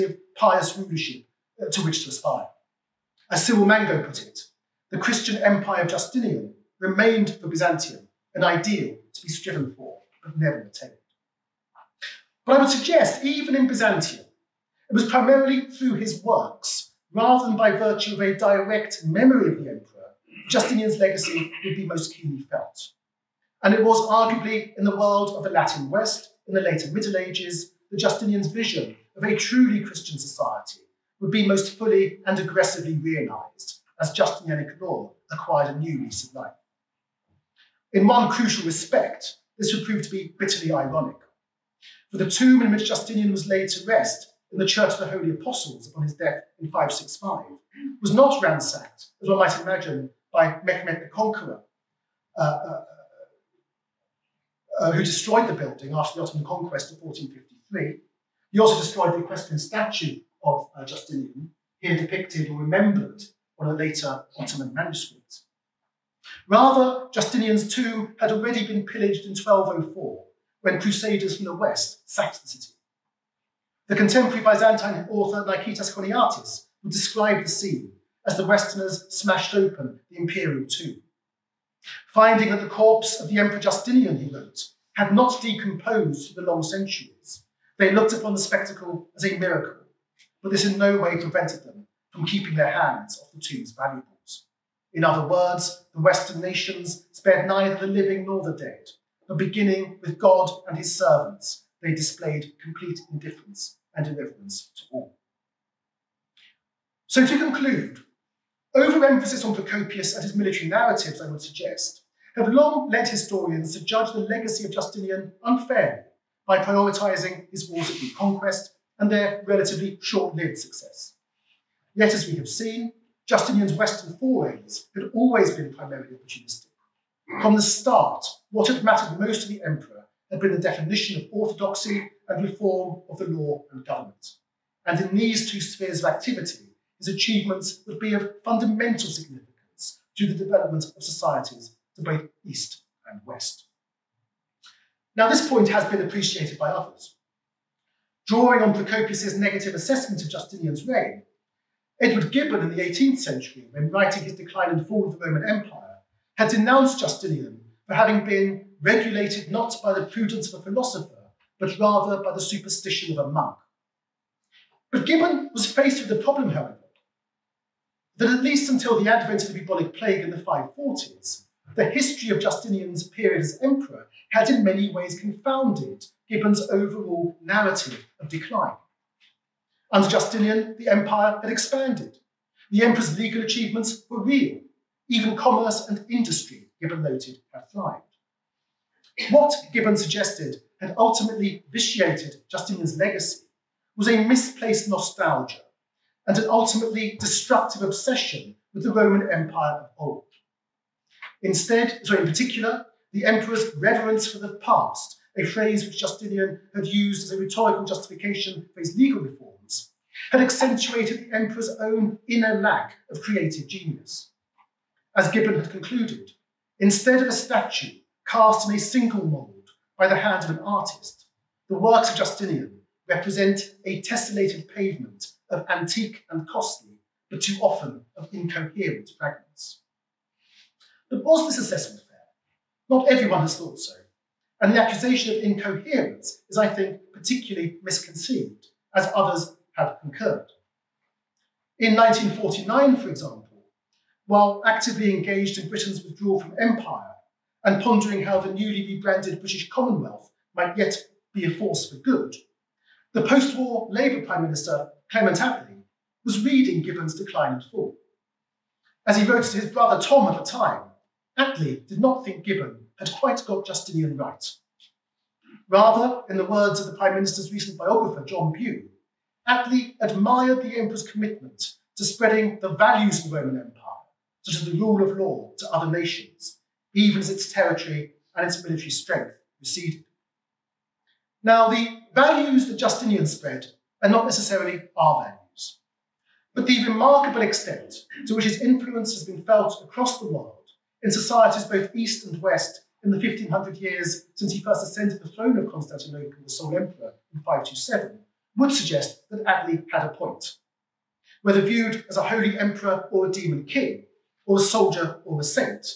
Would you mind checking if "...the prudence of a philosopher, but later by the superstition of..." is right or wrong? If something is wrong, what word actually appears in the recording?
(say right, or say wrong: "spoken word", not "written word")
wrong: "rather", not "later".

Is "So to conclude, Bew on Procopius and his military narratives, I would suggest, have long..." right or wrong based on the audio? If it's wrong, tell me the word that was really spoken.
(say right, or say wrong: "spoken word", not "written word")
wrong: "Overemphasis", not "Bew".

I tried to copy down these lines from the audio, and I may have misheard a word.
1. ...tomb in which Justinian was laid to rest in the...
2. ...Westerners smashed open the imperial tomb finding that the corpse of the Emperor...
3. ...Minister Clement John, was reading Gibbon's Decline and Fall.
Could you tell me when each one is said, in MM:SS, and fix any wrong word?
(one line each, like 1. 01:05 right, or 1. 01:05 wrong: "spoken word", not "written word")
1. 00:42 right
2. 01:18 right
3. 04:14 wrong: "Attlee", not "John".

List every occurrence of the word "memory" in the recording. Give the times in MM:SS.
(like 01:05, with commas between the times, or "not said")
00:19.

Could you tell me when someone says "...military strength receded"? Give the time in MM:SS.
04:38.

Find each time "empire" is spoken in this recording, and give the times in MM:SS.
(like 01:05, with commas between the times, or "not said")
00:05, 02:35, 03:00, 03:19, 04:06, 04:33.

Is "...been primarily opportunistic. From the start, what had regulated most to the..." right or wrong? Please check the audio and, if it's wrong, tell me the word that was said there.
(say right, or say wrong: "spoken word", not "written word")
wrong: "mattered", not "regulated".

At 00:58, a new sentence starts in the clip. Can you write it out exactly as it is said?
He also destroyed the equestrian statue of uh, Justinian, here depicted or remembered on a later Ottoman manuscript.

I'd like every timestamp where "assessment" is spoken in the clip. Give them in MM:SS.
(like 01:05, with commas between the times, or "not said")
02:29, 03:51.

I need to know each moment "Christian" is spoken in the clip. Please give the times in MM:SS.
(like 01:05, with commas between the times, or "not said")
00:04, 00:29.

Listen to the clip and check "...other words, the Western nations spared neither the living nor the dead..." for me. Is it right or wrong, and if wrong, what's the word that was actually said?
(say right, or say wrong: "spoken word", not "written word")
right.